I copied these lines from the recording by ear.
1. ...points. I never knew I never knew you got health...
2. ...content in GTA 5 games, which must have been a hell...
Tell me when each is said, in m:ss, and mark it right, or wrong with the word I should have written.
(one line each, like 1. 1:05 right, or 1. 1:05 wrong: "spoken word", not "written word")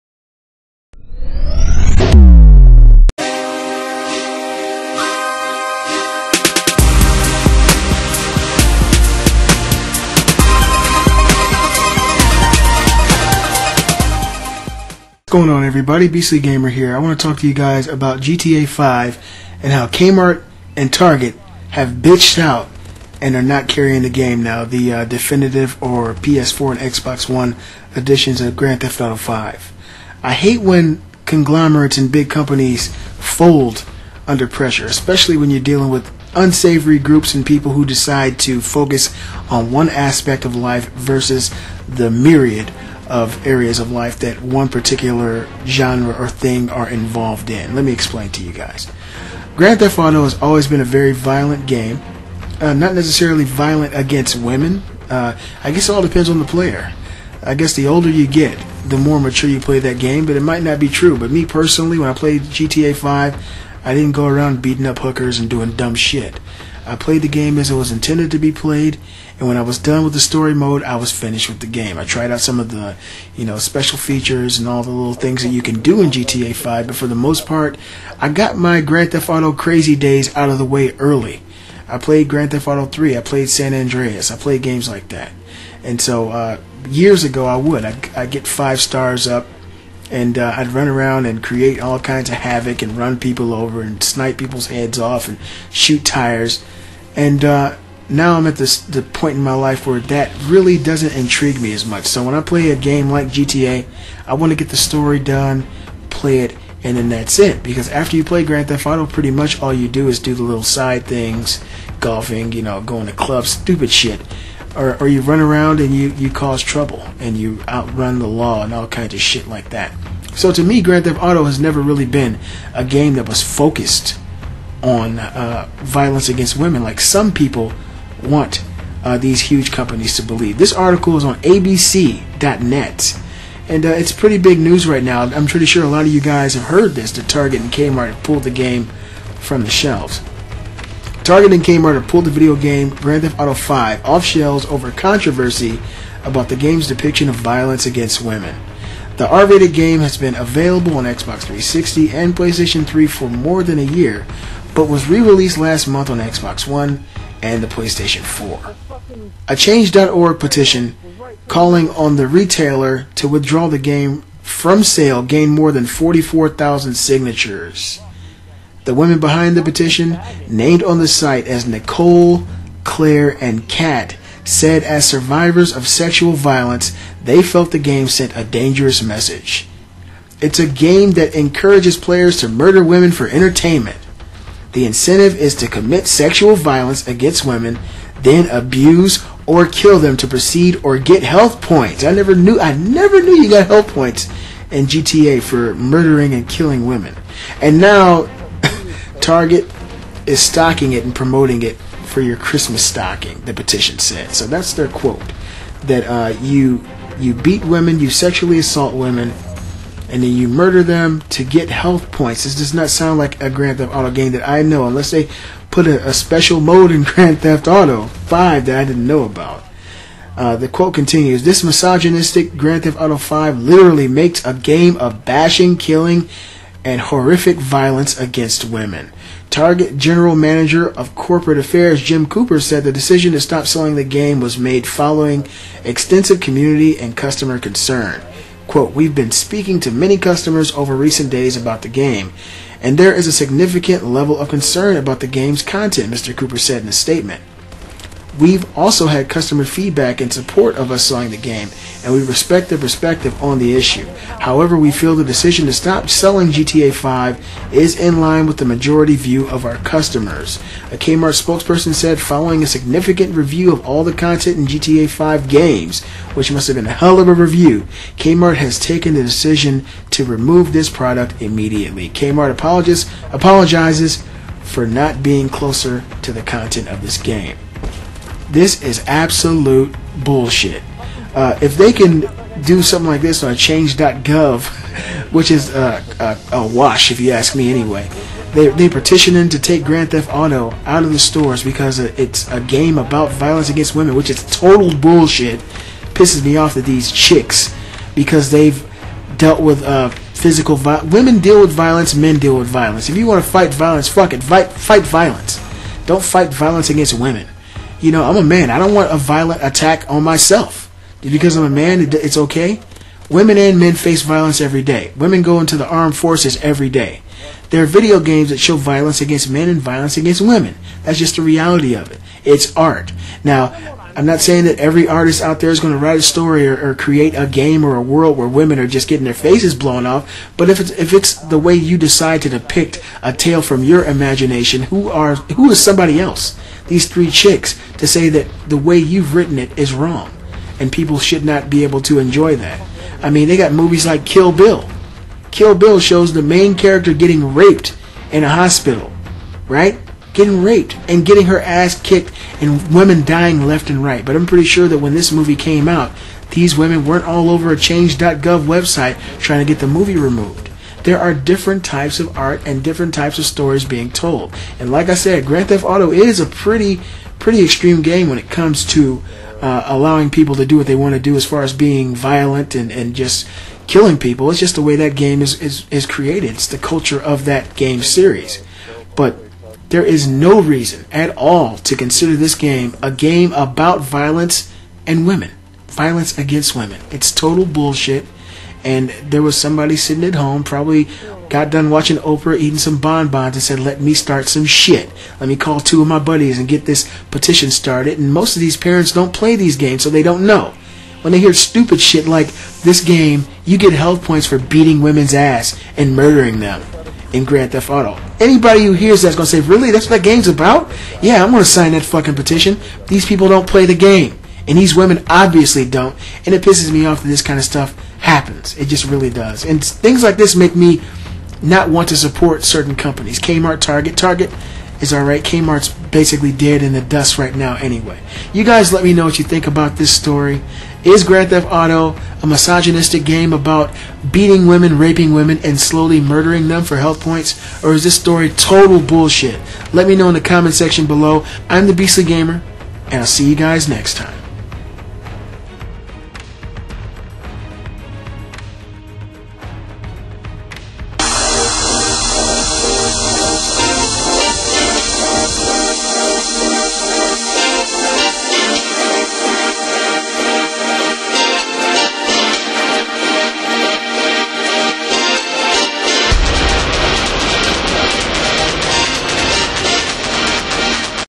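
1. 3:11 right
2. 4:24 right.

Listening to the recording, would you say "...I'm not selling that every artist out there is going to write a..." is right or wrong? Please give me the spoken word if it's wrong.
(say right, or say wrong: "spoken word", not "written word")
wrong: "saying", not "selling".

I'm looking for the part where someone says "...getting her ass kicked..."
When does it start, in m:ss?
5:51.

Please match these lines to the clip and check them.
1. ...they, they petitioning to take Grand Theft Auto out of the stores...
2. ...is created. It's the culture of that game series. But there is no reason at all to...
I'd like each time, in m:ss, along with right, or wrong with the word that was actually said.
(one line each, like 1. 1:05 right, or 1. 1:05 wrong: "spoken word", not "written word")
1. 4:48 right
2. 6:15 right.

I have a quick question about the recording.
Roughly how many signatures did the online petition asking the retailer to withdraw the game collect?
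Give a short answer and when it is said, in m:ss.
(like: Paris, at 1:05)
44,000, at 2:45.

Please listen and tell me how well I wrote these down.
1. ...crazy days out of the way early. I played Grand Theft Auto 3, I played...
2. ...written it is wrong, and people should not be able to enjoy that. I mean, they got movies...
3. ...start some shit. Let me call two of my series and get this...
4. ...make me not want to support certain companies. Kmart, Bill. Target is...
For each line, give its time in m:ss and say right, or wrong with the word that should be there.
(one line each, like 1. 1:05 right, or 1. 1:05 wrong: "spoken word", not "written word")
1. 1:19 right
2. 5:39 right
3. 6:34 wrong: "buddies", not "series"
4. 7:00 wrong: "Target", not "Bill".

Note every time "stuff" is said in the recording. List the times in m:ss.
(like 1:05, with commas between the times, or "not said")
6:57.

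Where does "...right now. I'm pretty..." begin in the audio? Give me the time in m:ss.
2:14.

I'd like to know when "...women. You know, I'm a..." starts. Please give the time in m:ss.
5:07.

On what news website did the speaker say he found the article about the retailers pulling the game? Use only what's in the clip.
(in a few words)
ABC.net.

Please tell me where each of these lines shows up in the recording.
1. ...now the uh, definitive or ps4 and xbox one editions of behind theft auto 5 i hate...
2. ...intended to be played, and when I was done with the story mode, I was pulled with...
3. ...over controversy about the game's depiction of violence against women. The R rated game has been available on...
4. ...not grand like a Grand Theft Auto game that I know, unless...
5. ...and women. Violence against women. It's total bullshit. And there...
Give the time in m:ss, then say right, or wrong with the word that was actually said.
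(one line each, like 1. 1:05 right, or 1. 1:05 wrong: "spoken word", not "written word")
1. 0:24 wrong: "grand", not "behind"
2. 1:07 wrong: "finished", not "pulled"
3. 2:24 right
4. 3:32 wrong: "sound", not "grand"
5. 6:25 right.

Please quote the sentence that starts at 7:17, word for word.
Or is this story total bullshit?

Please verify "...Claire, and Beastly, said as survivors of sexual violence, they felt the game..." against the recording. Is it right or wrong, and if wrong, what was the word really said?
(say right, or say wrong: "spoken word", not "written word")
wrong: "Kat", not "Beastly".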